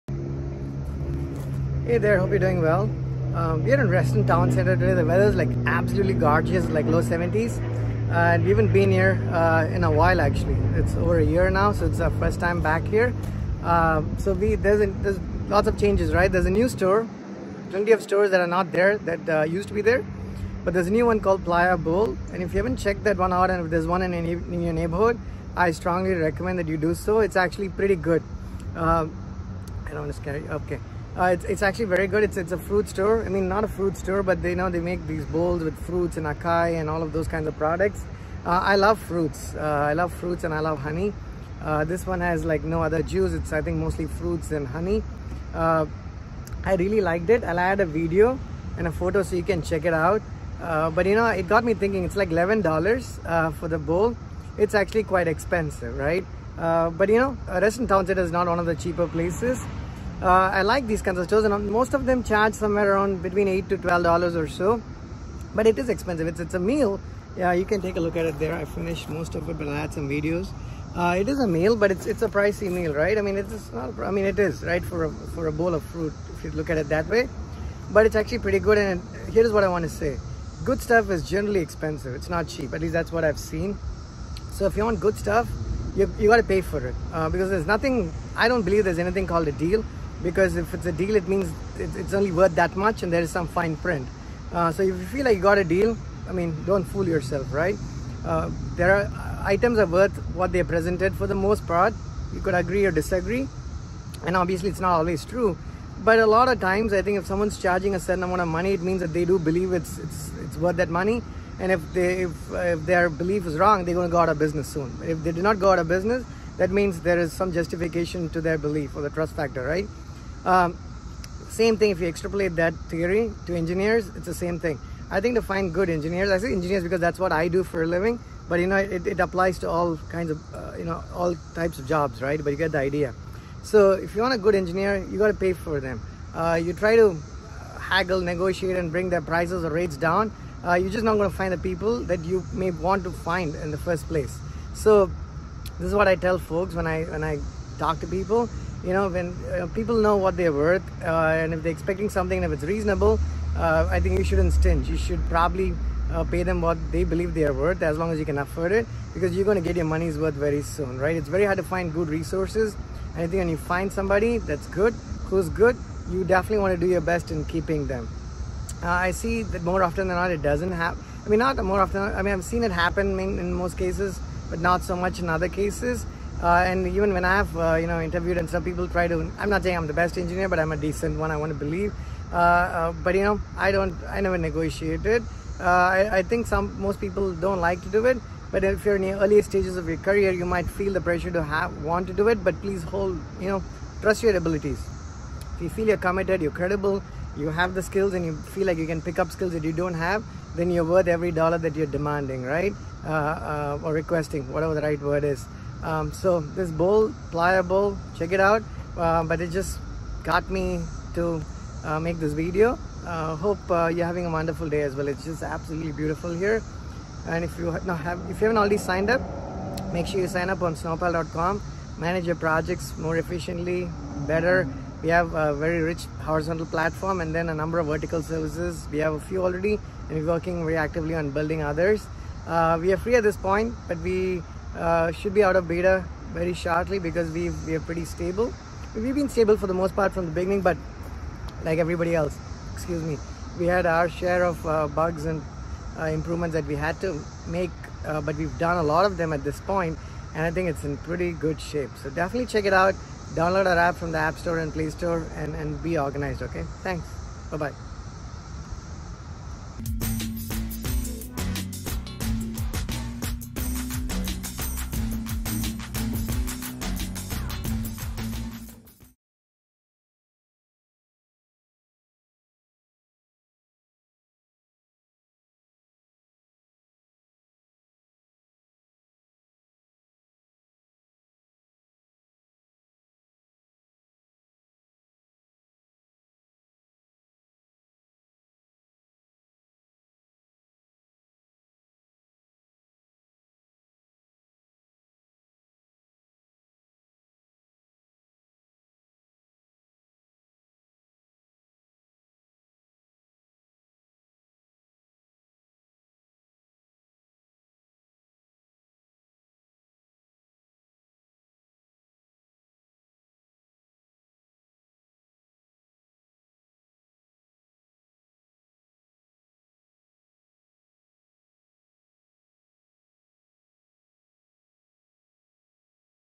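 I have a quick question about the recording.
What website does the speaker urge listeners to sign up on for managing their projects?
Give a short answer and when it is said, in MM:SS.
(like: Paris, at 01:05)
snowpal.com, at 03:40.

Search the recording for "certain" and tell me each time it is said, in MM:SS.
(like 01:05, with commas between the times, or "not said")
01:47.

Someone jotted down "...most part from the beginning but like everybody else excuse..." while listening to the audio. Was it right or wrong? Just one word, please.
right.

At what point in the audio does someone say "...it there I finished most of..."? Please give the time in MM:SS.
01:08.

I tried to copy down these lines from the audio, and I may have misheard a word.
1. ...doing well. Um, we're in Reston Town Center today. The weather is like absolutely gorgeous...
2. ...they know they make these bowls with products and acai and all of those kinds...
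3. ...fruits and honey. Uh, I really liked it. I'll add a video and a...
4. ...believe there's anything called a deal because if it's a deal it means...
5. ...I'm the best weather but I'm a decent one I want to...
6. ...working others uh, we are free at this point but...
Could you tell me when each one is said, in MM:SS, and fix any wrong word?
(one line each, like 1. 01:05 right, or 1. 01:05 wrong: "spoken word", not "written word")
1. 00:02 right
2. 00:34 wrong: "fruits", not "products"
3. 00:44 right
4. 01:28 right
5. 02:59 wrong: "engineer", not "weather"
6. 03:51 wrong: "building", not "working".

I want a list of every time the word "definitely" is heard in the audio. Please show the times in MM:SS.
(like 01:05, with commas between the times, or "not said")
02:46, 04:12.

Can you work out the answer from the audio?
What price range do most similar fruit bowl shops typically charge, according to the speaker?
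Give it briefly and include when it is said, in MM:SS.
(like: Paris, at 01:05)
$8 to $12, at 01:03.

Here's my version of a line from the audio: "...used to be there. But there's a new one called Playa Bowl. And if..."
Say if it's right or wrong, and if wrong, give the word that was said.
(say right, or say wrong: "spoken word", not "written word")
right.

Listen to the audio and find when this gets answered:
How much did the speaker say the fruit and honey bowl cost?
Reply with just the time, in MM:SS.
00:52.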